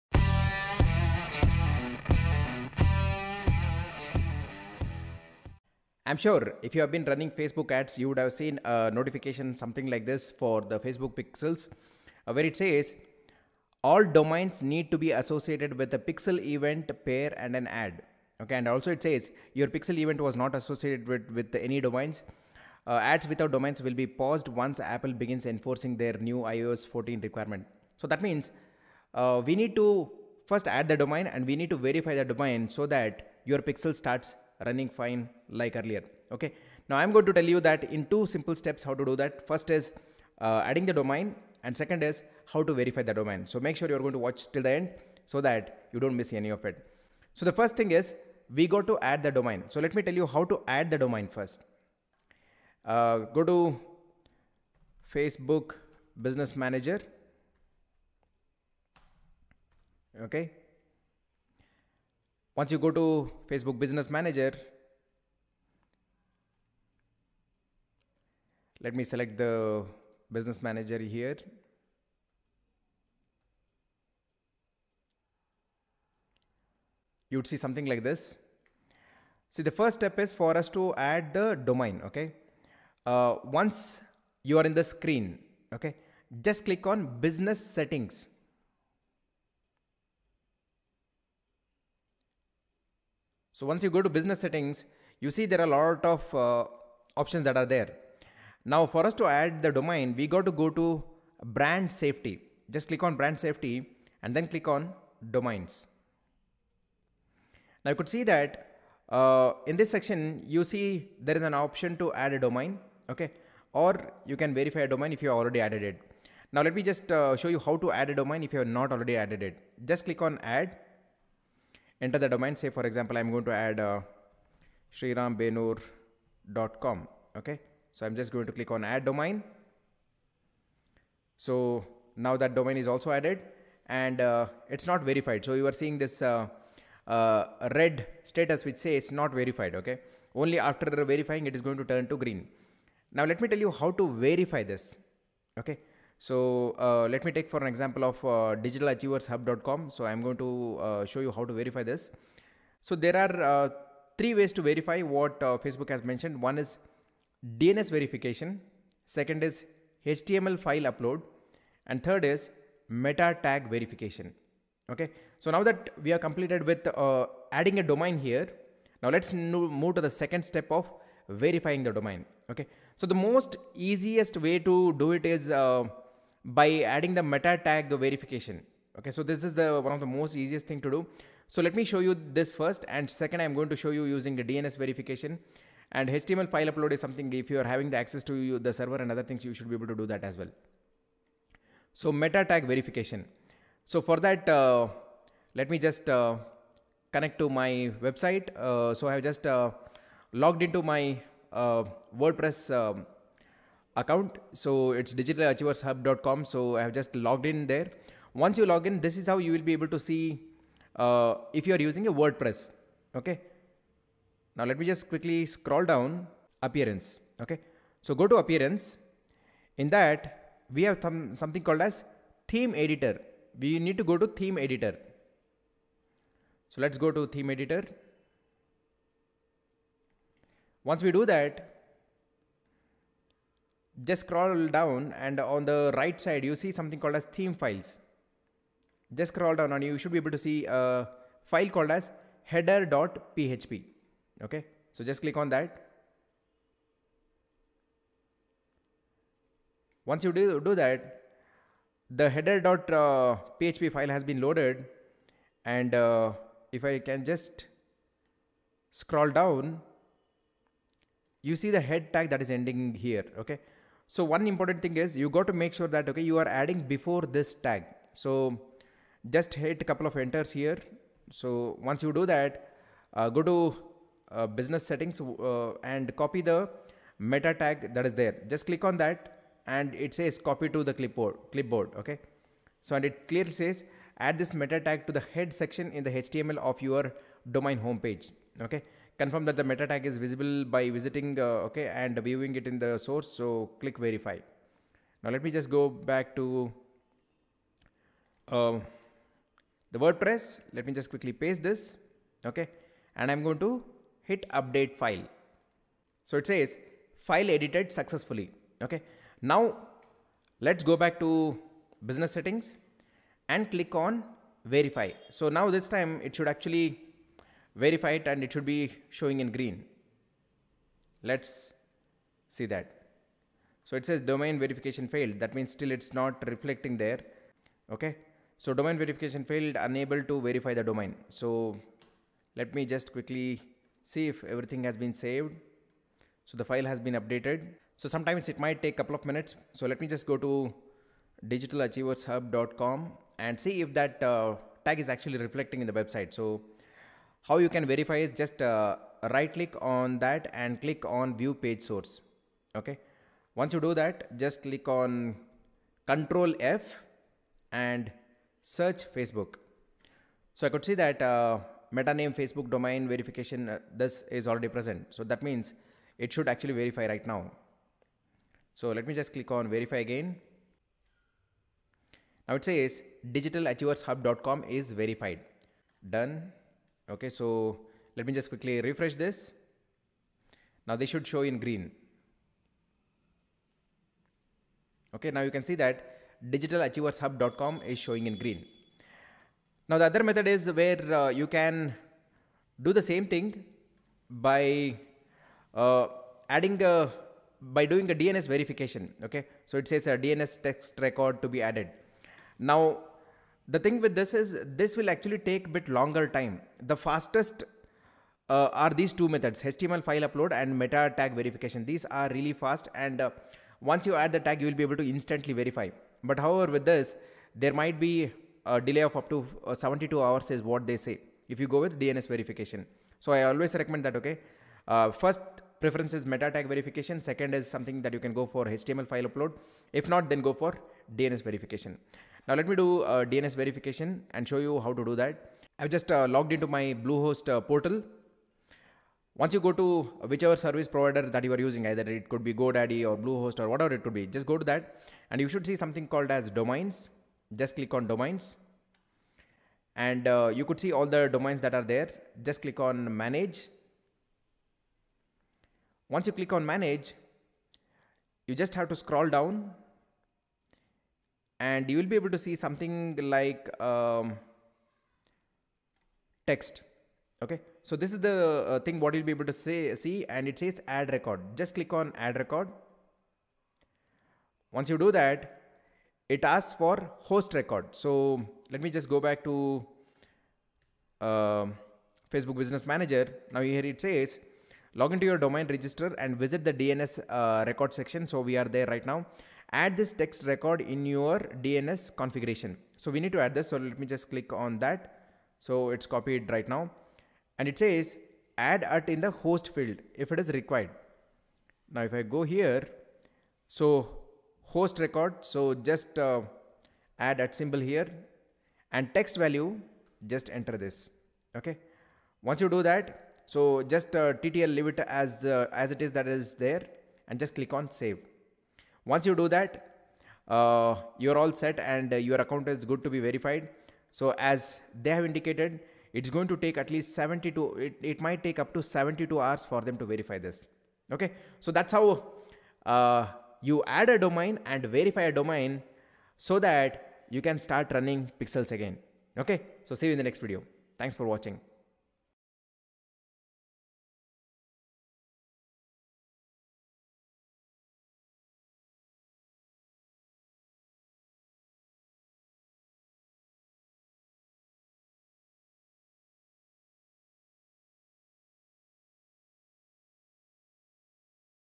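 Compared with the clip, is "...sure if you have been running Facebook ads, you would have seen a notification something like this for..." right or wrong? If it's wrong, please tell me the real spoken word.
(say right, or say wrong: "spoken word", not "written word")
right.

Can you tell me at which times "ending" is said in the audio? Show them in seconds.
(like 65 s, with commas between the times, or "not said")
262 s.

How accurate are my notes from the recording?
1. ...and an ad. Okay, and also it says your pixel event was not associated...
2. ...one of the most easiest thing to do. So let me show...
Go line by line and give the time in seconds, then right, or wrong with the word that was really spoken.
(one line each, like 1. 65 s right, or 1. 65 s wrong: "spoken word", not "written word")
1. 17 s right
2. 179 s right.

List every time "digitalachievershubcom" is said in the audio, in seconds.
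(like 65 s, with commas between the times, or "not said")
148 s, 205 s, 341 s, 373 s, 386 s.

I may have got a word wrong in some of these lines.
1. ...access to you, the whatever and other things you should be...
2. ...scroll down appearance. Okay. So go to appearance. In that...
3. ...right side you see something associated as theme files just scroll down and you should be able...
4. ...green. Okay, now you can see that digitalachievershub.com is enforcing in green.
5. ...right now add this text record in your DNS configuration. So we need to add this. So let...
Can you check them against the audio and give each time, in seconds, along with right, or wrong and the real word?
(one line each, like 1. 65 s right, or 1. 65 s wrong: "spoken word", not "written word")
1. 187 s wrong: "server", not "whatever"
2. 215 s right
3. 235 s wrong: "called", not "associated"
4. 381 s wrong: "showing", not "enforcing"
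5. 488 s right.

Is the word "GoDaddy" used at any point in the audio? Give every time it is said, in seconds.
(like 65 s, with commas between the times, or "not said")
442 s.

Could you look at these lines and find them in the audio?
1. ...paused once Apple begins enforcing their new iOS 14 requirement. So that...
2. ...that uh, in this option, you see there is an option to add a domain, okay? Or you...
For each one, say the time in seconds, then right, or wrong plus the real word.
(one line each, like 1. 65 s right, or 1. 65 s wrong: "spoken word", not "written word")
1. 24 s right
2. 108 s wrong: "section", not "option".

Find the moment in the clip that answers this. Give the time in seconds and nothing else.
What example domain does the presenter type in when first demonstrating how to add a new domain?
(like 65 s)
124 s.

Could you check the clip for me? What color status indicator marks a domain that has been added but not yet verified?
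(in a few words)
Red.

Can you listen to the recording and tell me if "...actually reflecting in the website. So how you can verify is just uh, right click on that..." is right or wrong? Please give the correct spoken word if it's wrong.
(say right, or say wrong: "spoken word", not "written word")
right.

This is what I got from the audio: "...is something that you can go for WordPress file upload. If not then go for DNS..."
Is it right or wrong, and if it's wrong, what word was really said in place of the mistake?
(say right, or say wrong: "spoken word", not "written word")
wrong: "HTML", not "WordPress".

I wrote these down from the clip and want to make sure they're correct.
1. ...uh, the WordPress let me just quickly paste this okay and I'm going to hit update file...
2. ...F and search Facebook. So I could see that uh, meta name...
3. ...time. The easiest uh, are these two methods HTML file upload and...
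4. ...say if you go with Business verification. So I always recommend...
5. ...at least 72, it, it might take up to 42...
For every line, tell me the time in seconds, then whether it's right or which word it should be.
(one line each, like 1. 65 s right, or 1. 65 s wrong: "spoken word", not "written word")
1. 298 s right
2. 356 s right
3. 406 s wrong: "fastest", not "easiest"
4. 420 s wrong: "DNS", not "Business"
5. 526 s wrong: "72", not "42".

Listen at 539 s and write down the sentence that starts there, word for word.
Okay, so see you in the next video.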